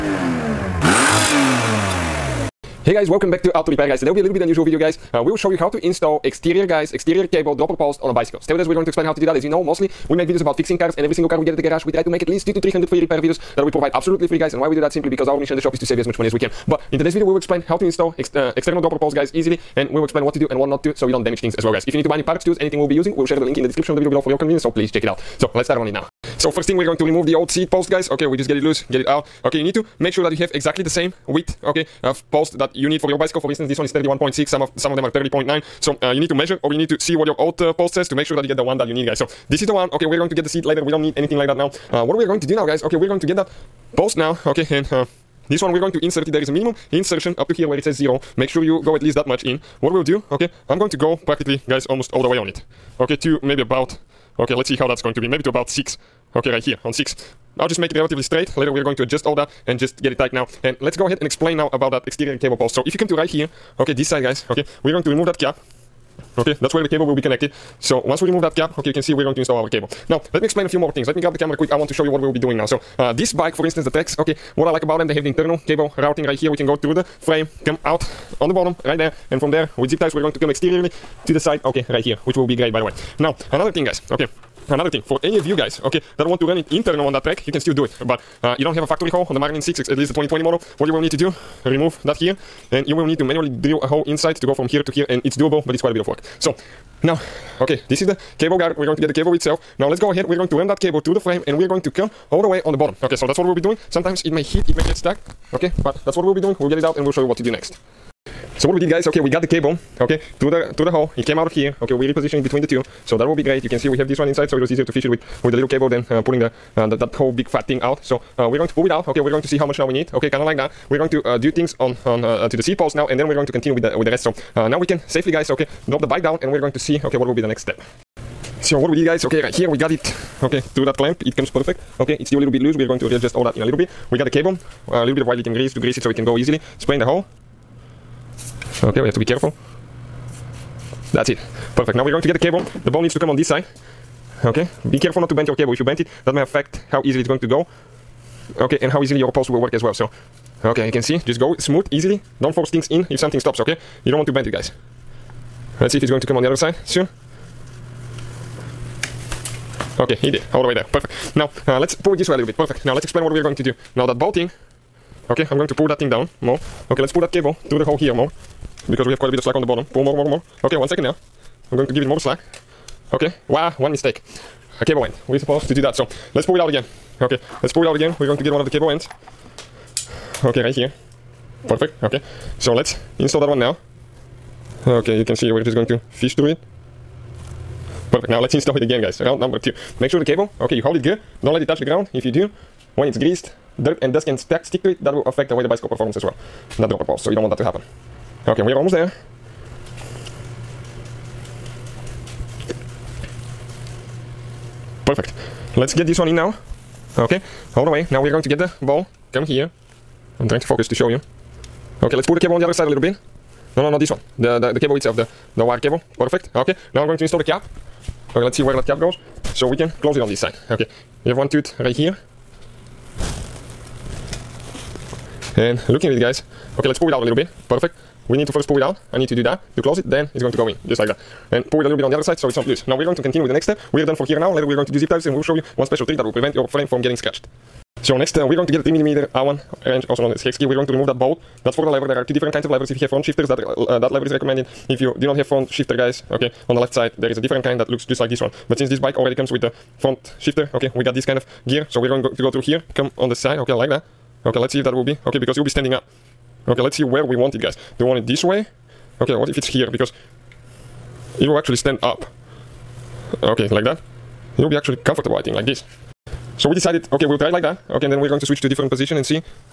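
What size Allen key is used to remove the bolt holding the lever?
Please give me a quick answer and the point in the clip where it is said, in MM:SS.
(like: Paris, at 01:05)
3mm, at 03:58.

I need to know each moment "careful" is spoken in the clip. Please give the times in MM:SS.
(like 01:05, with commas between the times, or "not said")
02:19, 02:24.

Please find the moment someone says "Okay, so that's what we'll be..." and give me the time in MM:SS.
01:43.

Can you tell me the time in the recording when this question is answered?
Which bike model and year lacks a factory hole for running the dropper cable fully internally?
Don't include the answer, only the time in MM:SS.
01:29.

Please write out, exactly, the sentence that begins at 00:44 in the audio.
Okay, and uh, this one we're going to insert it, there is a minimum insertion up to here where it says 0.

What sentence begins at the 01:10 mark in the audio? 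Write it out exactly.
Now, let me explain a few more things.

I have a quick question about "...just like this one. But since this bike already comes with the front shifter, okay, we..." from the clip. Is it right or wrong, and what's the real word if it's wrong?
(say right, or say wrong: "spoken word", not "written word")
right.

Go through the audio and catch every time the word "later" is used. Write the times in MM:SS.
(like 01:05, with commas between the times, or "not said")
00:40, 00:58, 03:54.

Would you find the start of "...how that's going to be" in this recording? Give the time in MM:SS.
00:54.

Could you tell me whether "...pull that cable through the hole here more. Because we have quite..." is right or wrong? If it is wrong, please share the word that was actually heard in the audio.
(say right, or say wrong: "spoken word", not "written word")
right.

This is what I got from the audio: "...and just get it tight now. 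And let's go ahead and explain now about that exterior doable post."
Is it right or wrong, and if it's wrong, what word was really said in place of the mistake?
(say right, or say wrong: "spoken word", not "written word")
wrong: "cable", not "doable".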